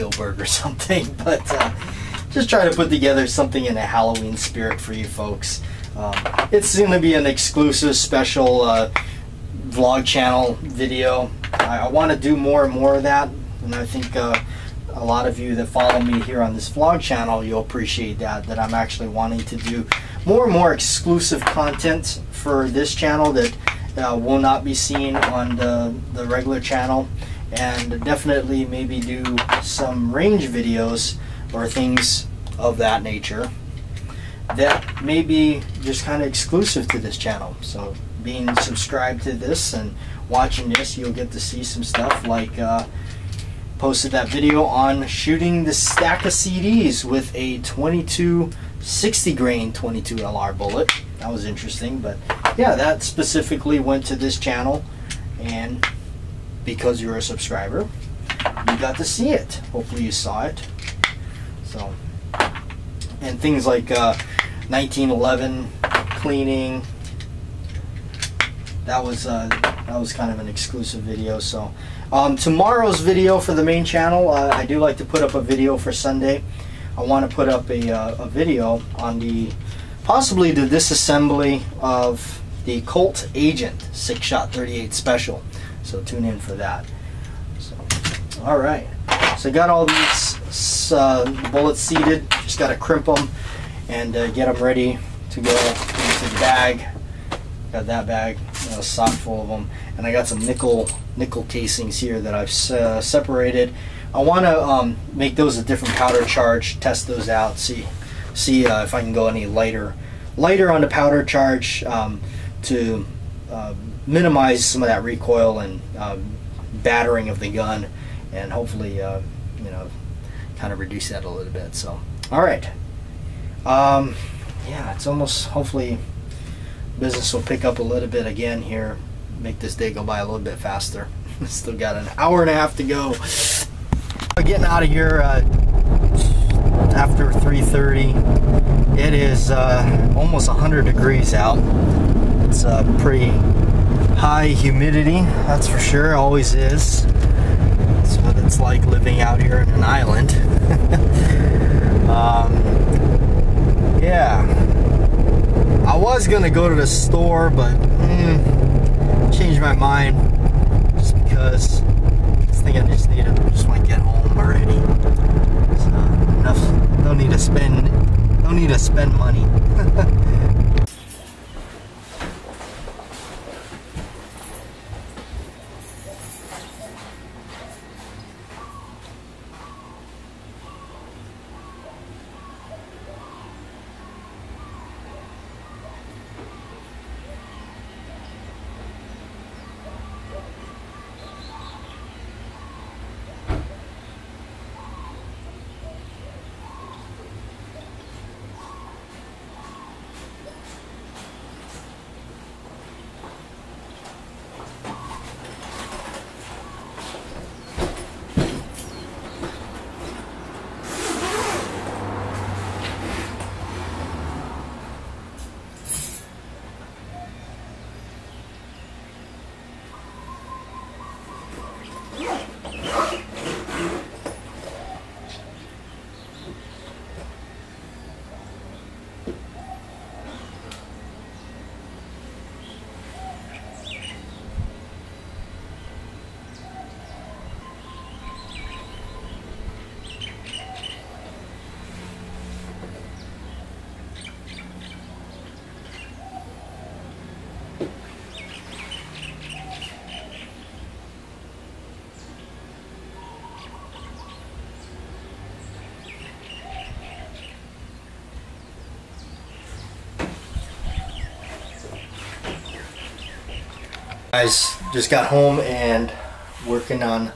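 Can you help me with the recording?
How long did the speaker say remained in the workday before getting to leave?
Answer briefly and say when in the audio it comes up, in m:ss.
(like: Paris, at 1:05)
an hour and a half, at 2:11.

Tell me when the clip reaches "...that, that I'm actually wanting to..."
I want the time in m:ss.
0:18.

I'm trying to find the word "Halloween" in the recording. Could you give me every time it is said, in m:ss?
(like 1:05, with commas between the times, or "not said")
0:03.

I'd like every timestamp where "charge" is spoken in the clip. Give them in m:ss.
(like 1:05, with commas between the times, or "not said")
1:46, 1:51.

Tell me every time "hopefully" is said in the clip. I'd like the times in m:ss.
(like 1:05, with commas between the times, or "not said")
0:59, 1:58, 2:05.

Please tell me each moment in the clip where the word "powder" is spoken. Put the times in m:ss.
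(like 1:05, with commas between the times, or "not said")
1:45, 1:50.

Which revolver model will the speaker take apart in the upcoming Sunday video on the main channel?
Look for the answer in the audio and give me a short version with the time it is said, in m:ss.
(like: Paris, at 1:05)
Colt Agent, at 1:22.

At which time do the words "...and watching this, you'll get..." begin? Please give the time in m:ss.
0:39.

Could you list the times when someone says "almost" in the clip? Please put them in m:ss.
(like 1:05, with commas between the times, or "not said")
2:05, 2:20.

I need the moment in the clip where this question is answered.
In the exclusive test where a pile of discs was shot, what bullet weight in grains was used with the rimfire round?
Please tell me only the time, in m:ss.
0:48.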